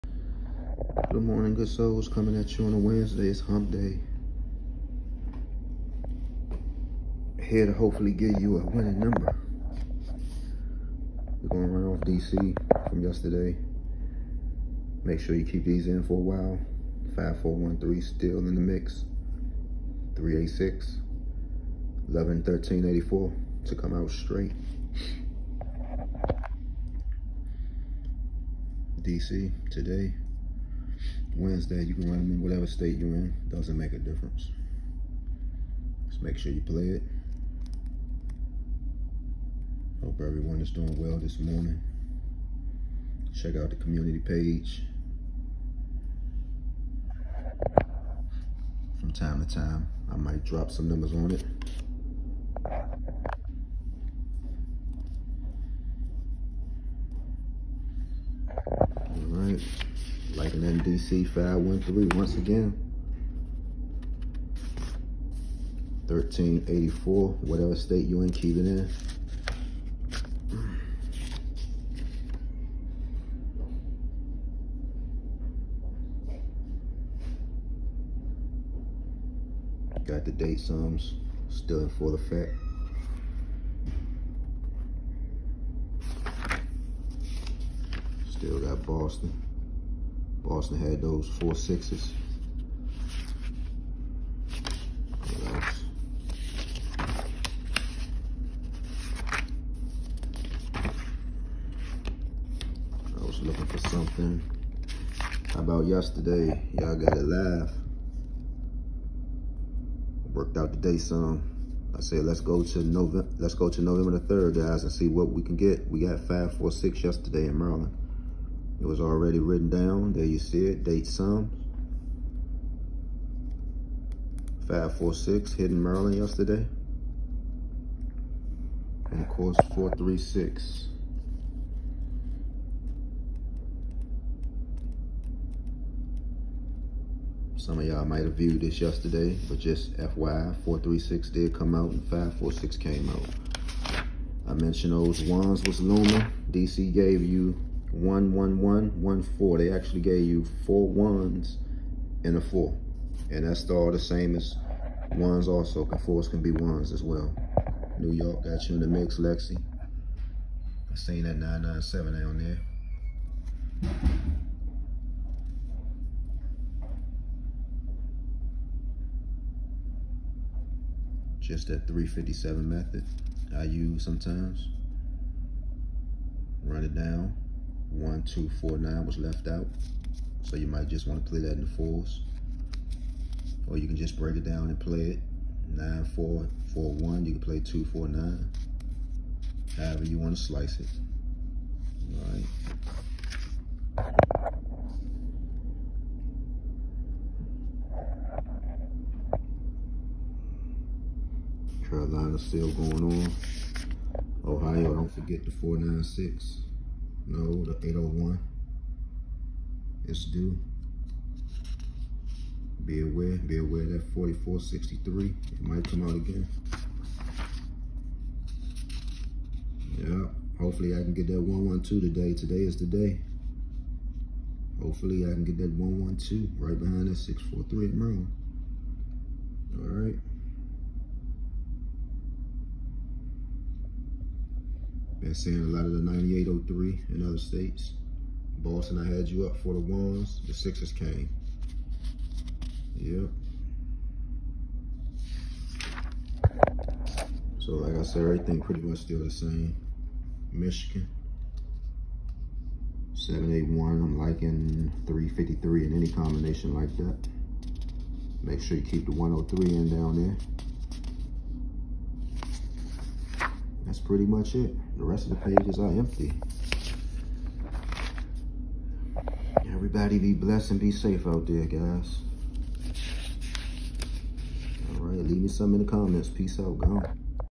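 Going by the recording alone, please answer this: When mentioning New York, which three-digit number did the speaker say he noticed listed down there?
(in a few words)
997.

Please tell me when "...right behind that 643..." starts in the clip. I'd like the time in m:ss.
3:46.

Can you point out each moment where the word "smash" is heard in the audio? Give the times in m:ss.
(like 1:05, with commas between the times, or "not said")
not said.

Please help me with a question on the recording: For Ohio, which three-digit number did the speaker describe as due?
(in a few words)
801.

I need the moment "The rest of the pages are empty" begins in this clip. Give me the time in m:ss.
4:24.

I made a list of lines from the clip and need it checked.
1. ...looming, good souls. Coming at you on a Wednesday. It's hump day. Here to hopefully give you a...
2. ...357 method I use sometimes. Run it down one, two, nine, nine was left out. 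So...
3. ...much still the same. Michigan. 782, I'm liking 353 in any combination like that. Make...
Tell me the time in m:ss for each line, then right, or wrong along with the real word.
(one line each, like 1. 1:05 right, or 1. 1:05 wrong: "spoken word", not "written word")
1. 0:01 wrong: "morning", not "looming"
2. 2:51 wrong: "four", not "nine"
3. 4:08 wrong: "781", not "782".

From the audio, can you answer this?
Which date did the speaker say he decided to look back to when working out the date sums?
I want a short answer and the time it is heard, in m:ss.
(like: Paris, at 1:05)
November 3, at 1:53.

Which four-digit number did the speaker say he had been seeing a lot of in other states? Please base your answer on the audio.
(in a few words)
9803.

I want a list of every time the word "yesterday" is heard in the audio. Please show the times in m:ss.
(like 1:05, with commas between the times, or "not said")
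0:13, 1:45, 1:57, 2:06, 2:18.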